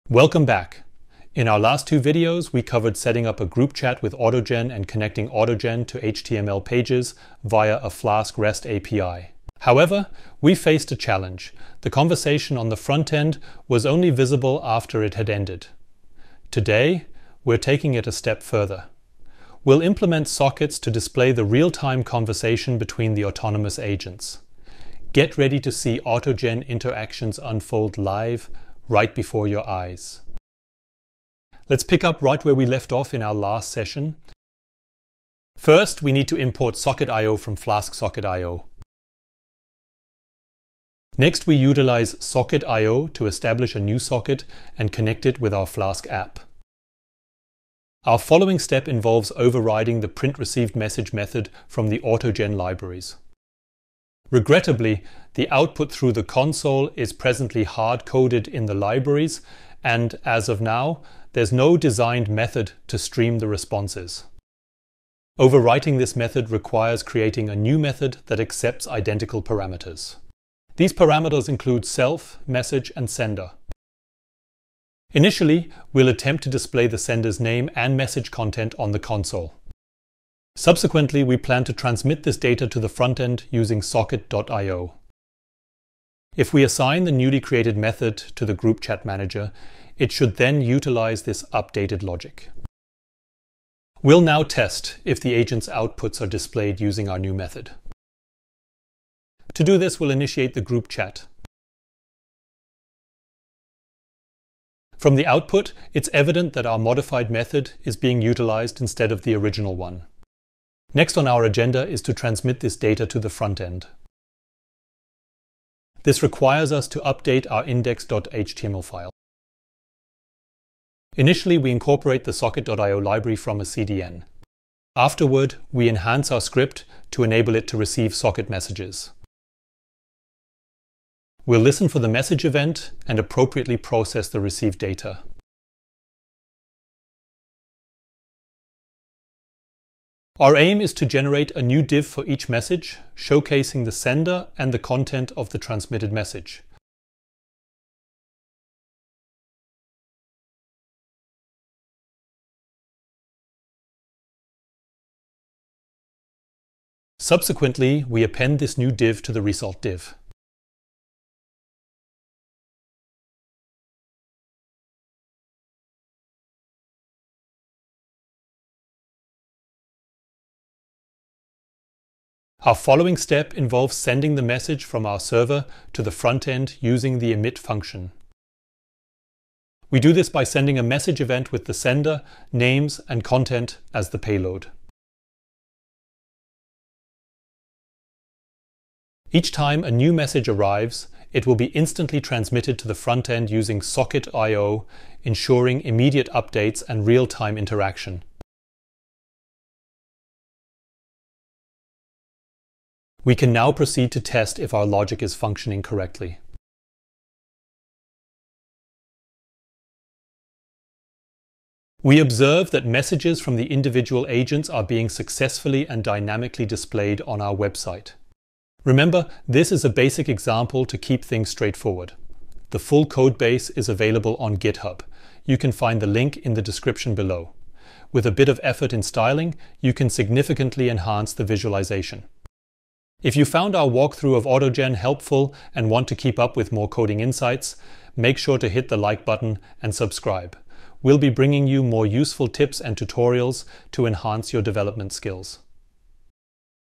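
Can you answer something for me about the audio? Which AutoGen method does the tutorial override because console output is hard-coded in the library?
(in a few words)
print received message.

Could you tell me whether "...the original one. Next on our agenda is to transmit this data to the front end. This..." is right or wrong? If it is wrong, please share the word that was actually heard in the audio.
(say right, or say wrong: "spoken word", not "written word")
right.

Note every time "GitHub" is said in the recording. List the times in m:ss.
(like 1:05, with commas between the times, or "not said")
3:44.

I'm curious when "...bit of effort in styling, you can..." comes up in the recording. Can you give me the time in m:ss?
3:48.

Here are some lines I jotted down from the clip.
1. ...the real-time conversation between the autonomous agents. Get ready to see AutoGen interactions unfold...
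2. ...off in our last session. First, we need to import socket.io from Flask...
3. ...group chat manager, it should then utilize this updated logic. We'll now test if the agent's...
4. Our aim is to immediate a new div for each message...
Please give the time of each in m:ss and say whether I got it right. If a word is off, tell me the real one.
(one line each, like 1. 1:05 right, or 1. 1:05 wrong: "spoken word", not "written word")
1. 0:21 right
2. 0:32 right
3. 1:28 right
4. 2:20 wrong: "generate", not "immediate".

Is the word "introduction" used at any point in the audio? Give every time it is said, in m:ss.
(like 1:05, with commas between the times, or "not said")
not said.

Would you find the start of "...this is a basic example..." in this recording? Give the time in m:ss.
3:39.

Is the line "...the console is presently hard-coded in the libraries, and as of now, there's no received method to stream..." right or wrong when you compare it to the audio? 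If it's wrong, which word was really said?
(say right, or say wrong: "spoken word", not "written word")
wrong: "designed", not "received".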